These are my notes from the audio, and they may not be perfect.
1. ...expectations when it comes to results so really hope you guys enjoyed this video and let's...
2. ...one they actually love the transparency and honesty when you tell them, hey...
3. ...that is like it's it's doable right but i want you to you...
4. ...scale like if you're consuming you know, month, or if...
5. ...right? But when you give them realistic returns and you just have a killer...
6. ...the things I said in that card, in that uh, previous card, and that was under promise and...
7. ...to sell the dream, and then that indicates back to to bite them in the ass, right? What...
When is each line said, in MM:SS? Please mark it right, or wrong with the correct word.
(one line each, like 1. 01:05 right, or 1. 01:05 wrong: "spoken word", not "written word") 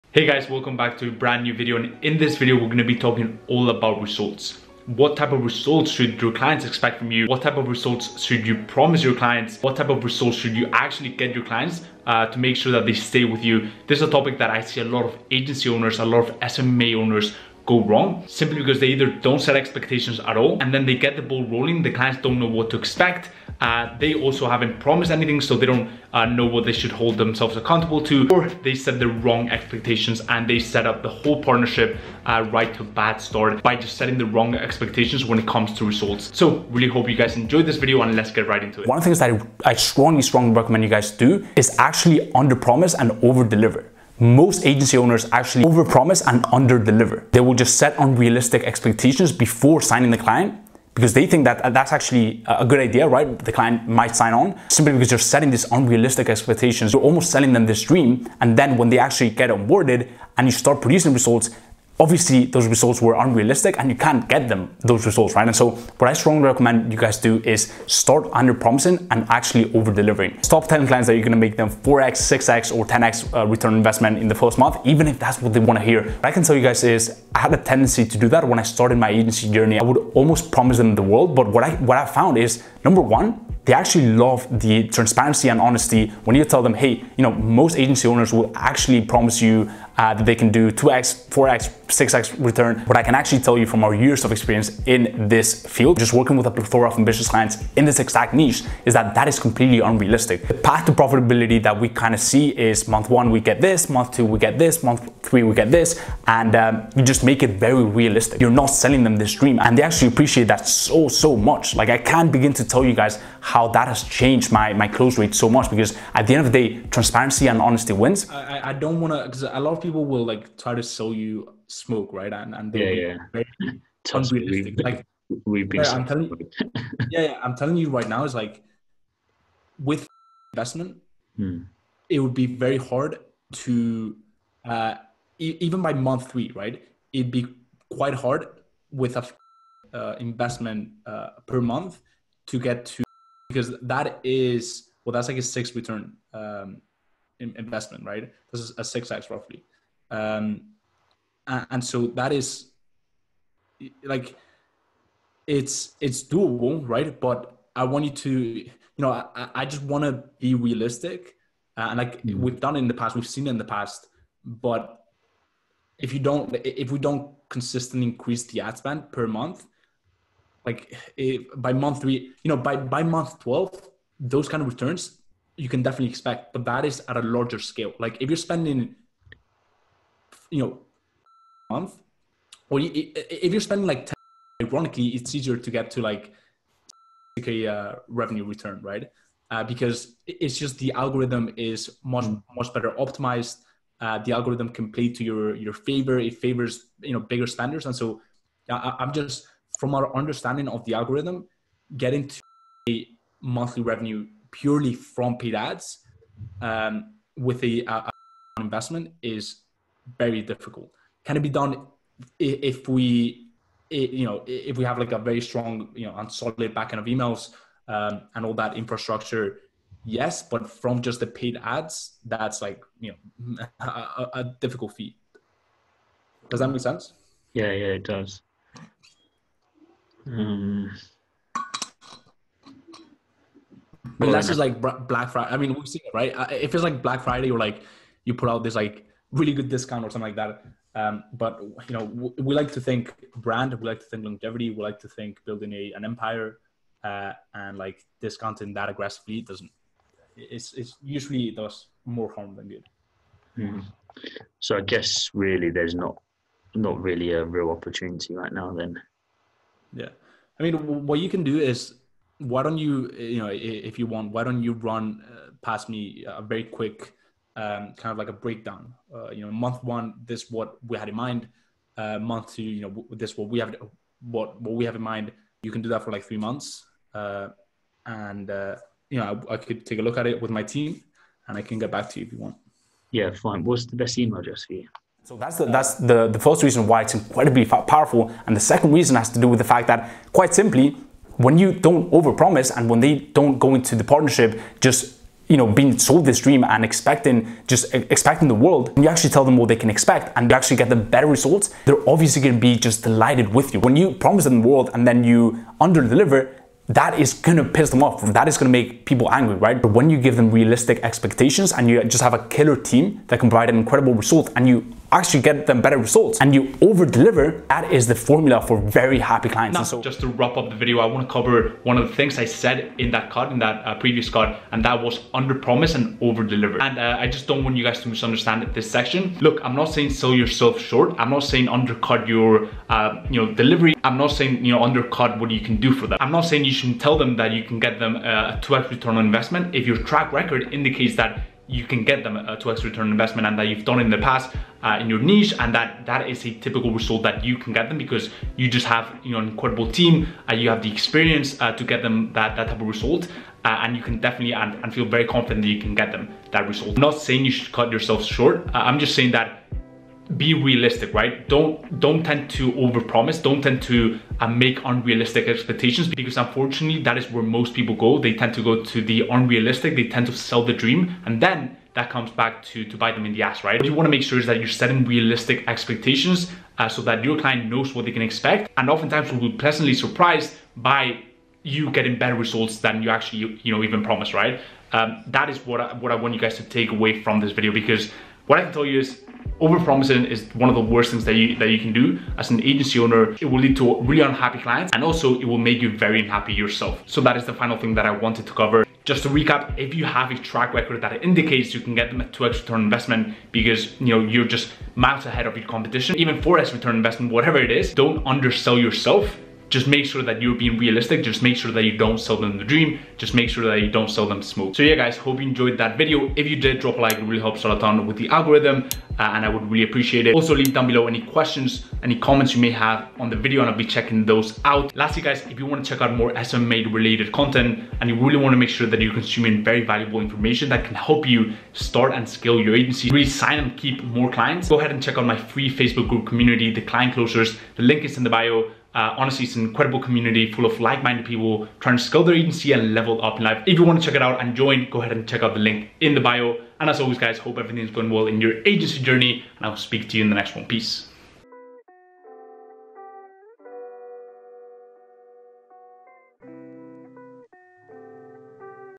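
1. 00:34 right
2. 01:23 right
3. 02:32 right
4. 02:57 wrong: "spending", not "consuming"
5. 05:09 wrong: "expectations", not "returns"
6. 05:22 right
7. 06:10 wrong: "comes", not "indicates".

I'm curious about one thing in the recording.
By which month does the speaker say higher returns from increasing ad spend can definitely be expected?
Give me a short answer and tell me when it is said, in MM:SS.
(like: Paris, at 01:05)
Month 12, at 02:53.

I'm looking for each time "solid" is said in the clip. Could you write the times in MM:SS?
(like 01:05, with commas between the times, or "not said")
03:36.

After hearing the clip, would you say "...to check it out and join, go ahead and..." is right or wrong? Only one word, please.
right.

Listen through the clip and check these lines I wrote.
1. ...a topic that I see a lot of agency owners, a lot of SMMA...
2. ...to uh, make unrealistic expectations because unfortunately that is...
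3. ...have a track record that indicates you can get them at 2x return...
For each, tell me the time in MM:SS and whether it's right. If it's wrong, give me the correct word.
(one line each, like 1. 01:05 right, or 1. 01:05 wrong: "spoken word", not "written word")
1. 00:14 right
2. 06:03 right
3. 06:40 right.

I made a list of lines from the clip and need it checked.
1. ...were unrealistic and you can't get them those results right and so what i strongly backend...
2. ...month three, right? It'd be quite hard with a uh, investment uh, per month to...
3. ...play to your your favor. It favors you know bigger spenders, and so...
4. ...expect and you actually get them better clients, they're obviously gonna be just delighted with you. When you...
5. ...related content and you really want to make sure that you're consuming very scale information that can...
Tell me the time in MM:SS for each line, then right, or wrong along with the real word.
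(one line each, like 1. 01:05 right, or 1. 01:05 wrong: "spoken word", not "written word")
1. 01:02 wrong: "recommend", not "backend"
2. 02:15 right
3. 03:14 right
4. 04:59 wrong: "results", not "clients"
5. 07:06 wrong: "valuable", not "scale".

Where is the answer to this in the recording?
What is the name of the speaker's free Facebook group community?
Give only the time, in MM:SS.
07:16.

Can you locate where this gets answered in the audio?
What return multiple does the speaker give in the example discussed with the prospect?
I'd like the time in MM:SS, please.
02:28.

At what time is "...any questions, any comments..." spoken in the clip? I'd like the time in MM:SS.
07:01.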